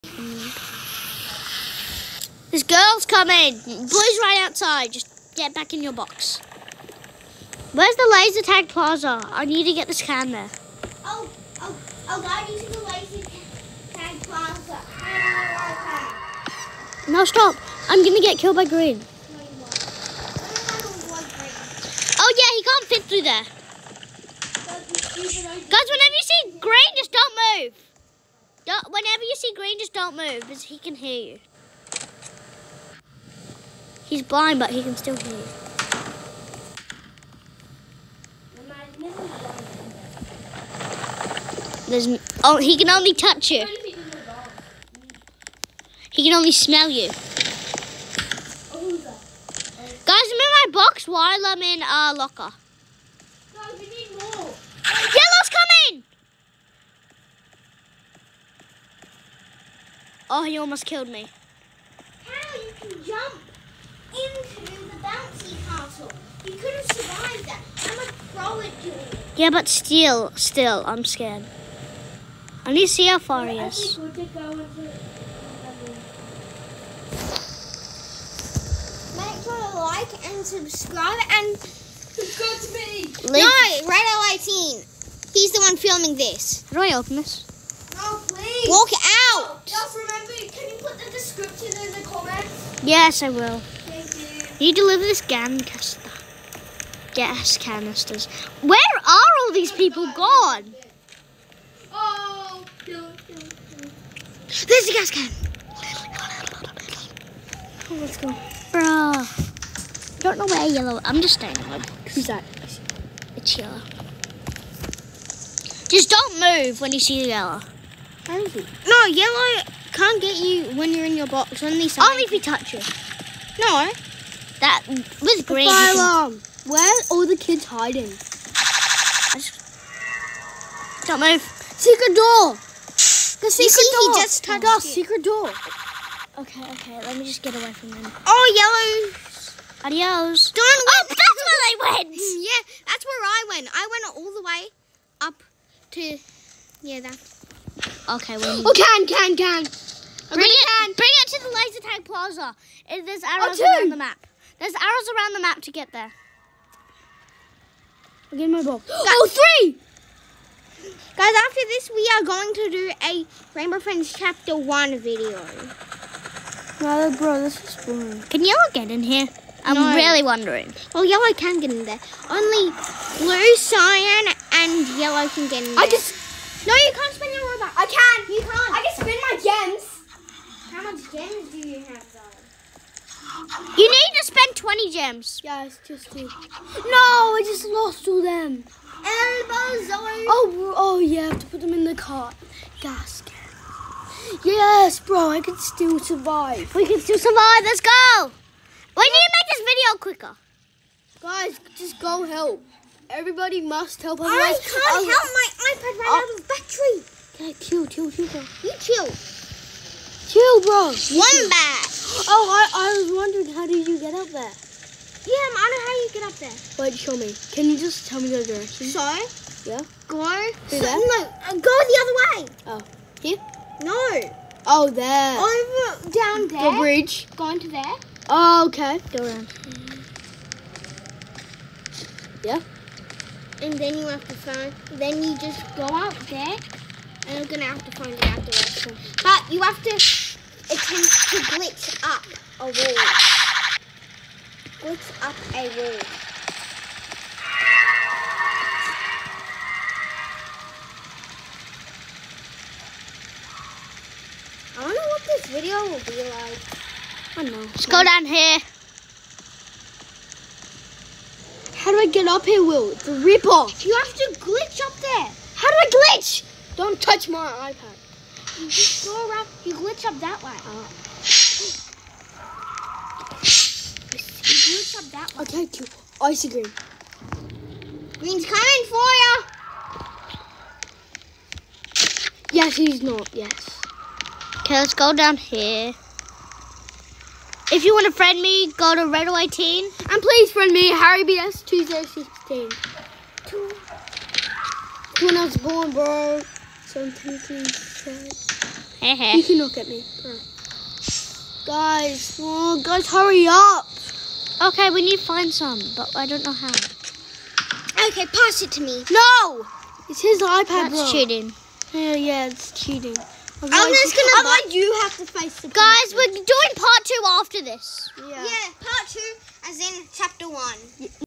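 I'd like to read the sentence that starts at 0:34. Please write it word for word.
He's blind, but he can still hear you.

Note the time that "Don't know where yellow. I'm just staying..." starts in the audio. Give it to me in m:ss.
1:50.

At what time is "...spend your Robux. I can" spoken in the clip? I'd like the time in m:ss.
2:57.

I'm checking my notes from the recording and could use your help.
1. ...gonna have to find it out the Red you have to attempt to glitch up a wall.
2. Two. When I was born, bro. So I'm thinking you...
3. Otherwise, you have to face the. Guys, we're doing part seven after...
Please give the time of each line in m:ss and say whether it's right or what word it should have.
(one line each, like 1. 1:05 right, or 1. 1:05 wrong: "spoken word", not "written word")
1. 3:57 wrong: "But", not "Red"
2. 4:53 right
3. 5:14 wrong: "two", not "seven".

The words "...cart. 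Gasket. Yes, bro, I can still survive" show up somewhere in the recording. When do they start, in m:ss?
3:11.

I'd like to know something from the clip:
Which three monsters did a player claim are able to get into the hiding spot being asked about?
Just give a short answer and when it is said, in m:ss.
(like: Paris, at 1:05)
Blue, cyan, and yellow, at 2:52.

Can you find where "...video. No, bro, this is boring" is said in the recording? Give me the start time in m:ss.
2:44.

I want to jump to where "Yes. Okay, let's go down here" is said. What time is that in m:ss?
4:43.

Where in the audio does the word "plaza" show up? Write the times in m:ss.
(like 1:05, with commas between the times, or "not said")
0:08, 0:14, 2:32.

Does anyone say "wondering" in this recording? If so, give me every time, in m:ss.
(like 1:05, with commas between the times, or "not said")
2:50, 3:33.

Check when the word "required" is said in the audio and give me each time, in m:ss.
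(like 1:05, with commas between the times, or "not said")
not said.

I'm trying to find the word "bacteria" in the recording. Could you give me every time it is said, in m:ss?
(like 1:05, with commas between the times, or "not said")
not said.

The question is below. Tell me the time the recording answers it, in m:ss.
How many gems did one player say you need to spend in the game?
3:03.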